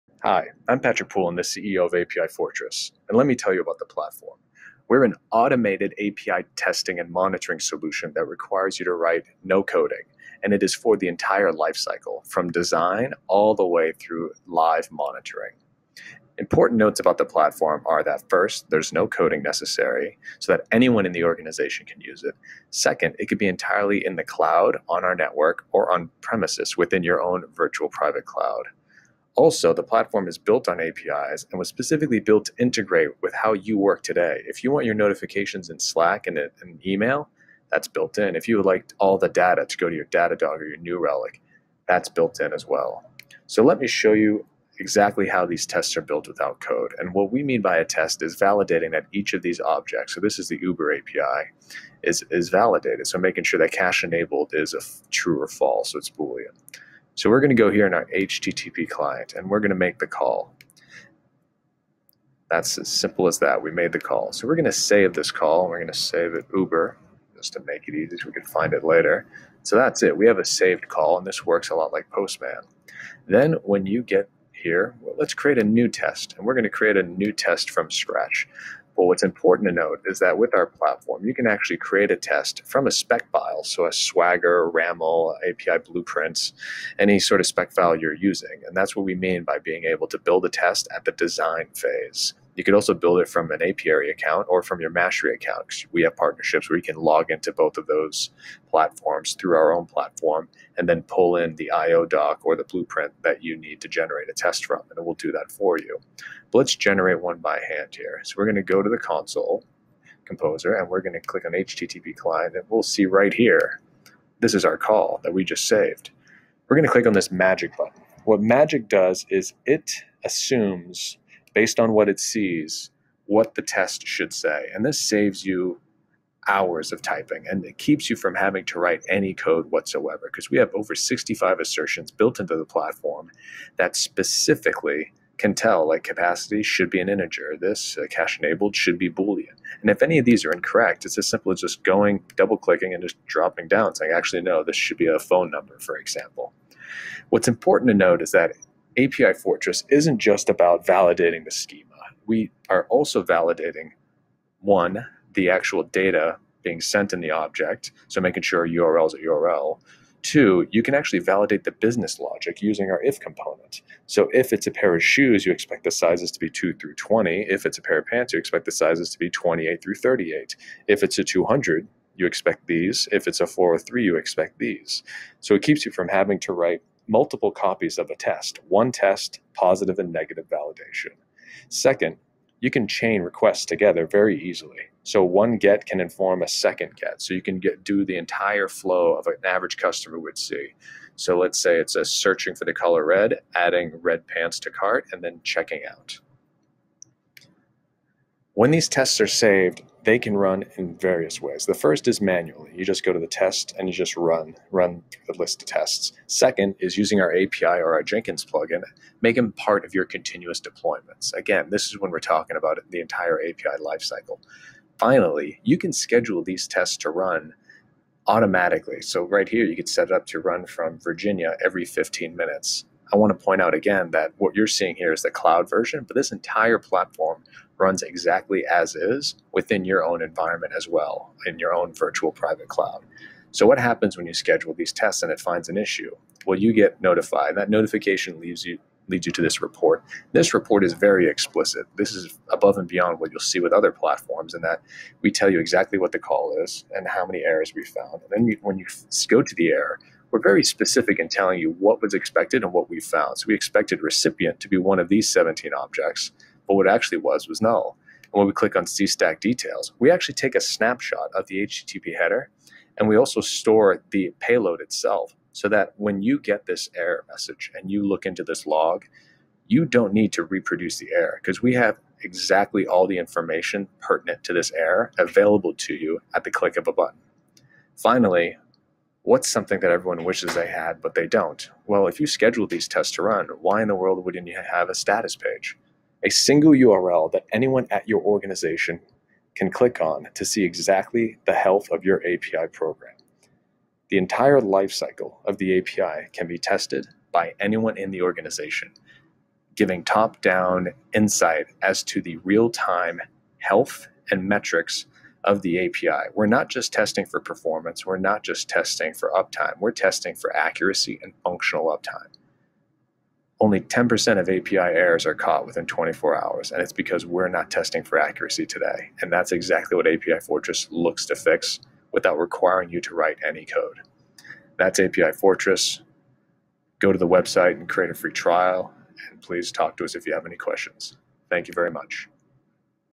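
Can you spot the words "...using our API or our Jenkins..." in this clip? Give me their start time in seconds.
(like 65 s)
206 s.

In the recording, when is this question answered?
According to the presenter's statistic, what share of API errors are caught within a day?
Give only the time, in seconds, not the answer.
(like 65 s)
313 s.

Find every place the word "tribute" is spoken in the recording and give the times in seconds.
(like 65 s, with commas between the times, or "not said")
not said.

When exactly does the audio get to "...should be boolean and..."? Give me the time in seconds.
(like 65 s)
138 s.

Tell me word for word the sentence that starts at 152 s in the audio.
We are also validating one, the actual data being sent in the object, so making sure URL is a URL.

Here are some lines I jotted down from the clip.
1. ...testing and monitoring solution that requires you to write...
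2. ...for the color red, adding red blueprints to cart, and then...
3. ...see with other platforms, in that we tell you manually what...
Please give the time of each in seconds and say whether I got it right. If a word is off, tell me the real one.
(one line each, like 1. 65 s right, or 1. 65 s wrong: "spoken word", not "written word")
1. 6 s right
2. 192 s wrong: "pants", not "blueprints"
3. 243 s wrong: "exactly", not "manually".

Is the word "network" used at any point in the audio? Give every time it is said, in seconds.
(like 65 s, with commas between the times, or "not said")
25 s.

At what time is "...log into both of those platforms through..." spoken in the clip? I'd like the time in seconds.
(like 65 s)
96 s.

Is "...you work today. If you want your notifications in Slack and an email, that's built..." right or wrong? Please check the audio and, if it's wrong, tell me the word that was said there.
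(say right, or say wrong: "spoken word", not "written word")
right.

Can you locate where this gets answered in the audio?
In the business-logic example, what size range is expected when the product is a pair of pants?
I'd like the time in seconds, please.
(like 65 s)
169 s.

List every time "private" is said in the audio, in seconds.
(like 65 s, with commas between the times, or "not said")
27 s, 232 s.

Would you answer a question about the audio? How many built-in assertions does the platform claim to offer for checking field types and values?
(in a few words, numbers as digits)
Over 65.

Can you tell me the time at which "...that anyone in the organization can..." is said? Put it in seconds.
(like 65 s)
20 s.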